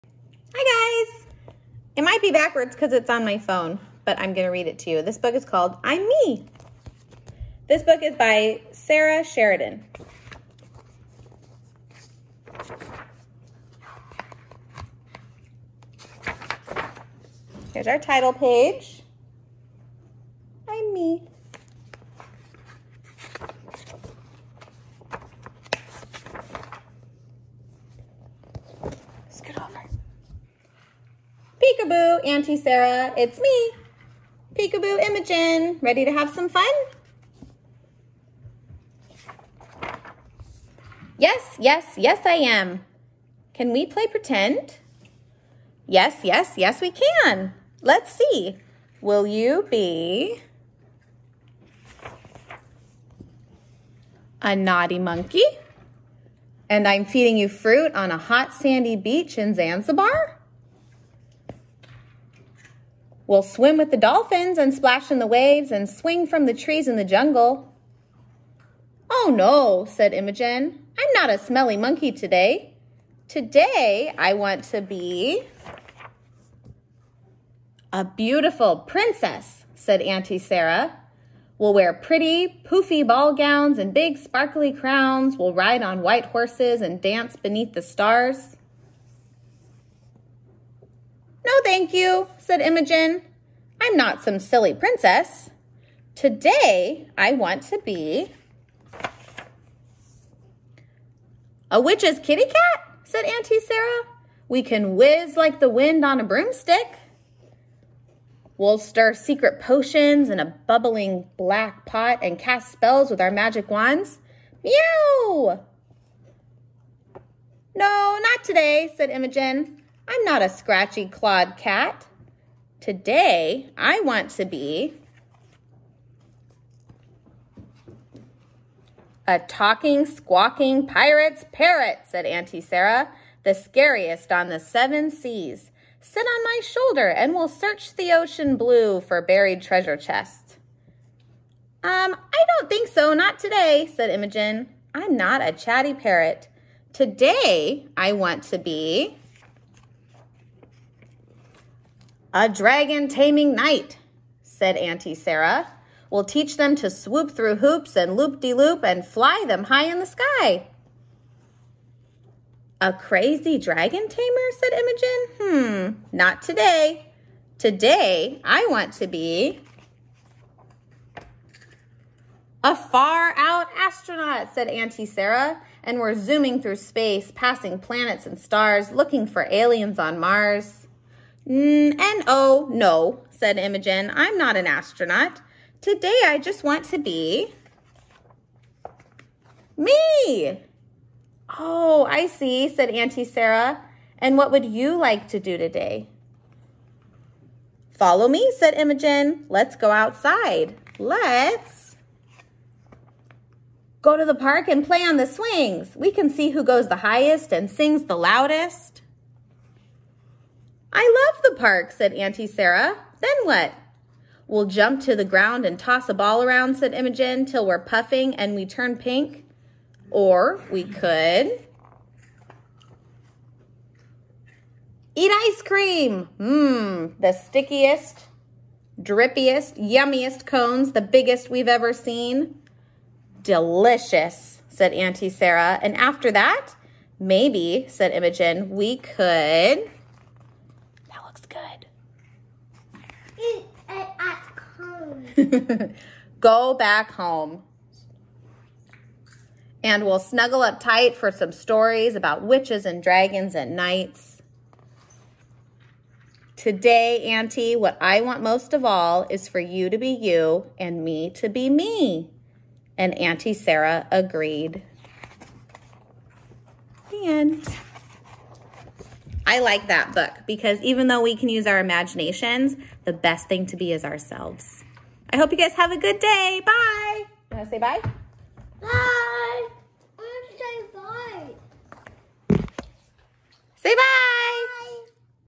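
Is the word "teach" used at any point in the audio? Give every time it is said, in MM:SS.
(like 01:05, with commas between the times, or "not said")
02:36.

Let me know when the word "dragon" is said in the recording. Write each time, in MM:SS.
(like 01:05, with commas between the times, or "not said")
02:32, 02:43, 04:13.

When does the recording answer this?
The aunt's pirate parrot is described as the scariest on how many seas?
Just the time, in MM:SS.
02:14.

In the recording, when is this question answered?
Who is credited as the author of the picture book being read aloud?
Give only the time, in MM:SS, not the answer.
00:08.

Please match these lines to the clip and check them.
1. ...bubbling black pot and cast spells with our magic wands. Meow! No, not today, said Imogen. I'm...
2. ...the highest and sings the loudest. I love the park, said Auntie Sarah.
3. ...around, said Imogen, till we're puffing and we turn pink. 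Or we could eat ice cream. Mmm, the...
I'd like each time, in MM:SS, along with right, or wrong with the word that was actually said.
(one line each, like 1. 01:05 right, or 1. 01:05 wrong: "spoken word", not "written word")
1. 01:50 right
2. 03:26 right
3. 03:36 right.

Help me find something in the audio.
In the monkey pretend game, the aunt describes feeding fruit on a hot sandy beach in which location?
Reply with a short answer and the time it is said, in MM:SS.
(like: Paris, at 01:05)
Zanzibar, at 00:59.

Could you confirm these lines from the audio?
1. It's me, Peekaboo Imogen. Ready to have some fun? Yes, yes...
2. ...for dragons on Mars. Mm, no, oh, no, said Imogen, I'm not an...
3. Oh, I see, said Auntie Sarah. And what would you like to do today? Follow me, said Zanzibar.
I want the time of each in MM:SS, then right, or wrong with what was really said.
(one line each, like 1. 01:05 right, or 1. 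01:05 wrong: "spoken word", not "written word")
1. 00:33 right
2. 02:59 wrong: "aliens", not "dragons"
3. 03:11 wrong: "Imogen", not "Zanzibar".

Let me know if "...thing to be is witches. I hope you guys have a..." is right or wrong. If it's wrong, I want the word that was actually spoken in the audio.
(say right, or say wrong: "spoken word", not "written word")
wrong: "ourselves", not "witches".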